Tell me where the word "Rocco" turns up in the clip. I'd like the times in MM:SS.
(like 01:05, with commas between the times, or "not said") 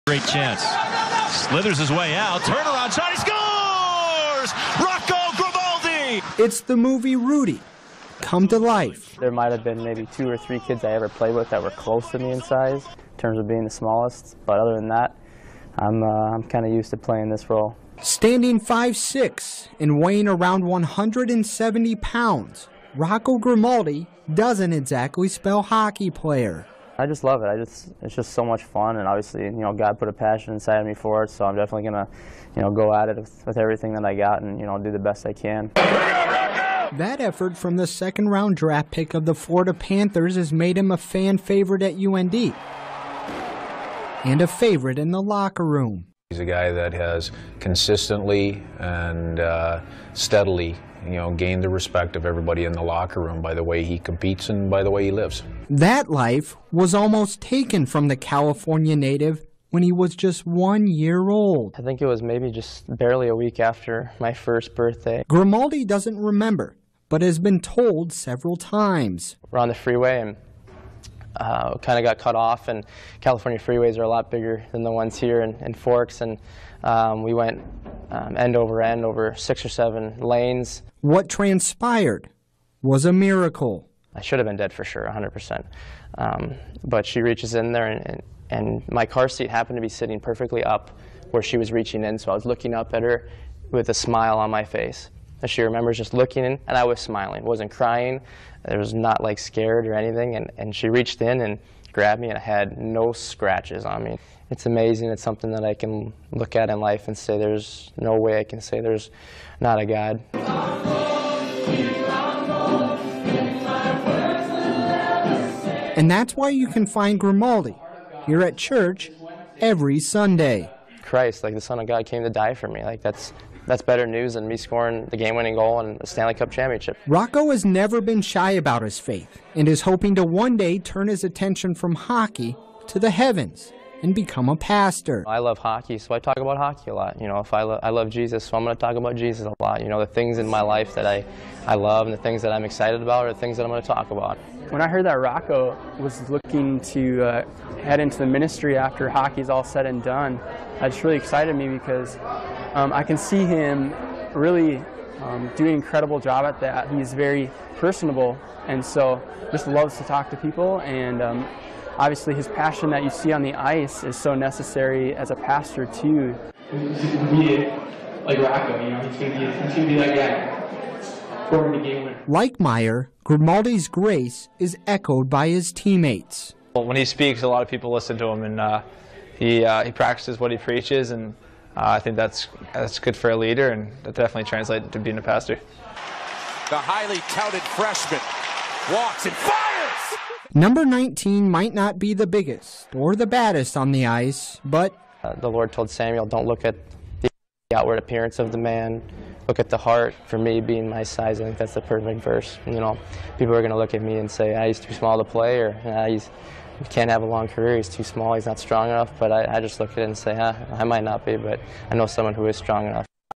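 00:04, 00:22, 02:07, 02:25, 02:48.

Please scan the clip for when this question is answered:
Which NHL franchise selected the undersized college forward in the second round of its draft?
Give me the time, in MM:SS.
00:39.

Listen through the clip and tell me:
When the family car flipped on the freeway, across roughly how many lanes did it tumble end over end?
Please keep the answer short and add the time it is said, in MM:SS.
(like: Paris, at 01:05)
6 or 7, at 01:19.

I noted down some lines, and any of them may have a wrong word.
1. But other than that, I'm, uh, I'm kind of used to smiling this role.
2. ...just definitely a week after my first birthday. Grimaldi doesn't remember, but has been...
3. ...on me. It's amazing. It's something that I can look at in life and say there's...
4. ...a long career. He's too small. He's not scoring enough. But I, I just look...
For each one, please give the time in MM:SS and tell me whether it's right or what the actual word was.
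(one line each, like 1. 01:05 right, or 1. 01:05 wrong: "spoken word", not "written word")
1. 00:14 wrong: "playing", not "smiling"
2. 01:02 wrong: "barely", not "definitely"
3. 01:43 right
4. 03:27 wrong: "strong", not "scoring".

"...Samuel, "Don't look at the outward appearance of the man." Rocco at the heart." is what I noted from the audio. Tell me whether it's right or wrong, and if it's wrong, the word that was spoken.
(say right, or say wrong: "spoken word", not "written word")
wrong: "Look", not "Rocco".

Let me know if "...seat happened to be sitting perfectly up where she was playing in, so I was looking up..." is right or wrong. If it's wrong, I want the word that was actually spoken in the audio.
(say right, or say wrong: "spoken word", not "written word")
wrong: "reaching", not "playing".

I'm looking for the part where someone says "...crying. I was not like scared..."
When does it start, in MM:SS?
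01:37.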